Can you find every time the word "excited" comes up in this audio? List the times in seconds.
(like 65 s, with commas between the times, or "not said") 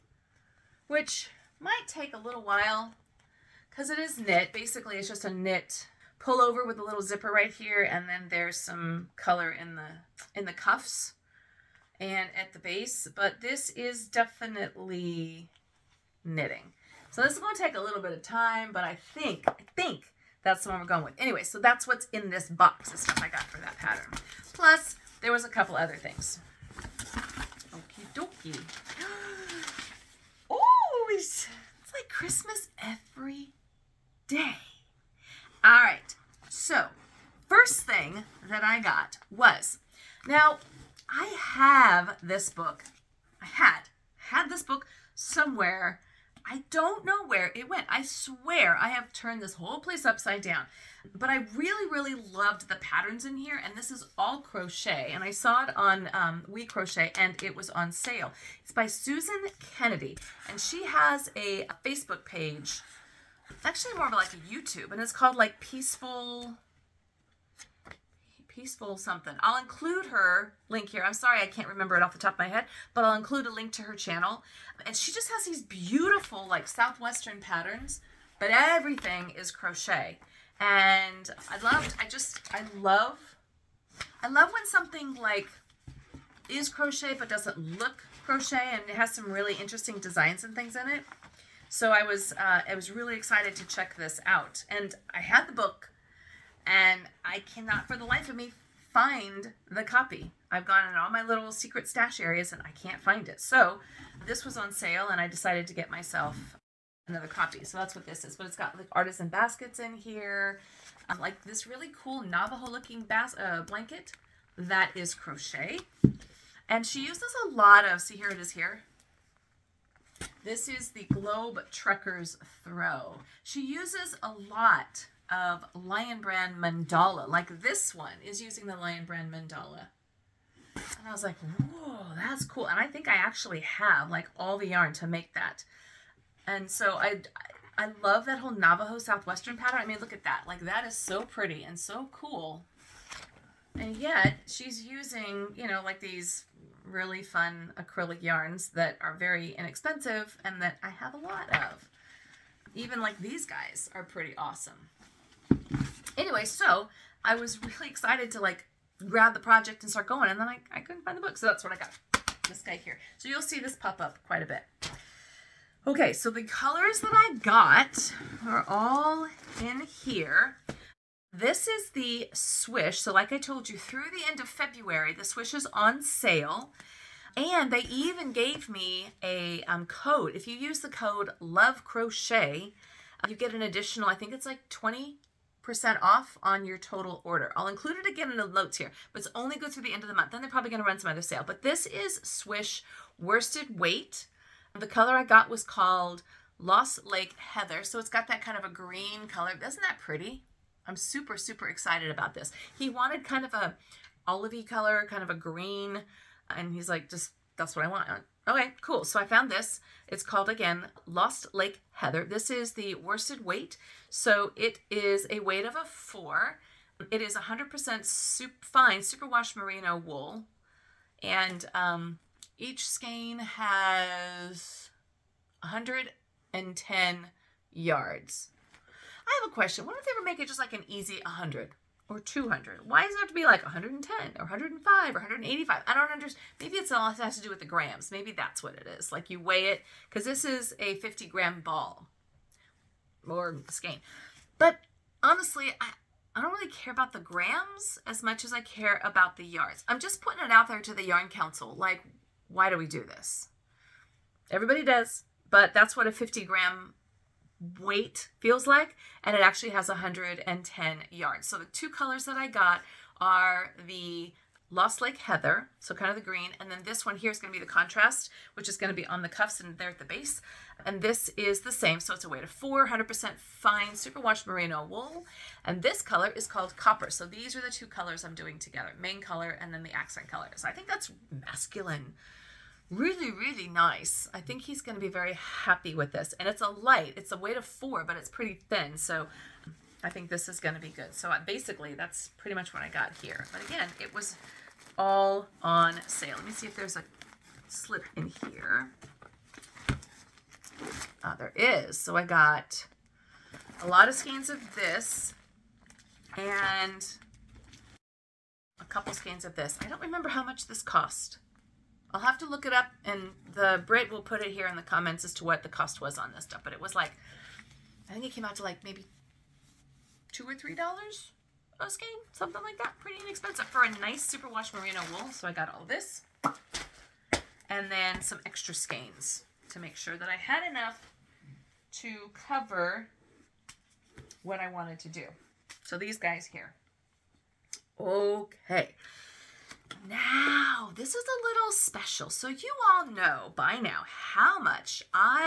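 93 s, 157 s, 201 s.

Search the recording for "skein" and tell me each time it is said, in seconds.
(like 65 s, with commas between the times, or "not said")
222 s, 243 s, 304 s, 309 s, 321 s, 328 s.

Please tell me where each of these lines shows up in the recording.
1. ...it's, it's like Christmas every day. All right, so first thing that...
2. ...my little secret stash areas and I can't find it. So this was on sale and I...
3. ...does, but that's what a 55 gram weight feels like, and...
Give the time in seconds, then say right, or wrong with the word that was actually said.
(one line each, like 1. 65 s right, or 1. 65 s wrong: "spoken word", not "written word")
1. 31 s right
2. 101 s right
3. 254 s wrong: "50", not "55".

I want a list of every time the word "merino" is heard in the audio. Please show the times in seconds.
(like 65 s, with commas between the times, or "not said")
219 s, 274 s, 324 s.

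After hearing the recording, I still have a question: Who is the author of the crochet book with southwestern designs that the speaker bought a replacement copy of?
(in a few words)
Susan Kennedy.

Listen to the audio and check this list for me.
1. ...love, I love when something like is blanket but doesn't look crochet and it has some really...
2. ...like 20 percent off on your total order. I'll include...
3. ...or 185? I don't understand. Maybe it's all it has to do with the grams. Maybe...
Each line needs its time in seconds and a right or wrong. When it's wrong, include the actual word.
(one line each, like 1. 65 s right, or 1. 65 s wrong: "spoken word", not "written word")
1. 82 s wrong: "crochet", not "blanket"
2. 184 s right
3. 235 s right.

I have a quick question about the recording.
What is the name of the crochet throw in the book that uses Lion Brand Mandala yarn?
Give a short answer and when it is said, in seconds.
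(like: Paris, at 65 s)
Globe Trekkers Throw, at 121 s.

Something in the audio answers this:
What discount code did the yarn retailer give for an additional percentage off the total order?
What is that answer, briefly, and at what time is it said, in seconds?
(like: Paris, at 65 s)
Love Crochet, at 181 s.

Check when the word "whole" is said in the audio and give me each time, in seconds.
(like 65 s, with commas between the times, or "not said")
49 s, 138 s.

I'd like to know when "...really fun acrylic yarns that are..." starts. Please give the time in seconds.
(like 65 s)
146 s.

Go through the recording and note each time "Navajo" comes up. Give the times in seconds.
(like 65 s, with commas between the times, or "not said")
112 s, 138 s.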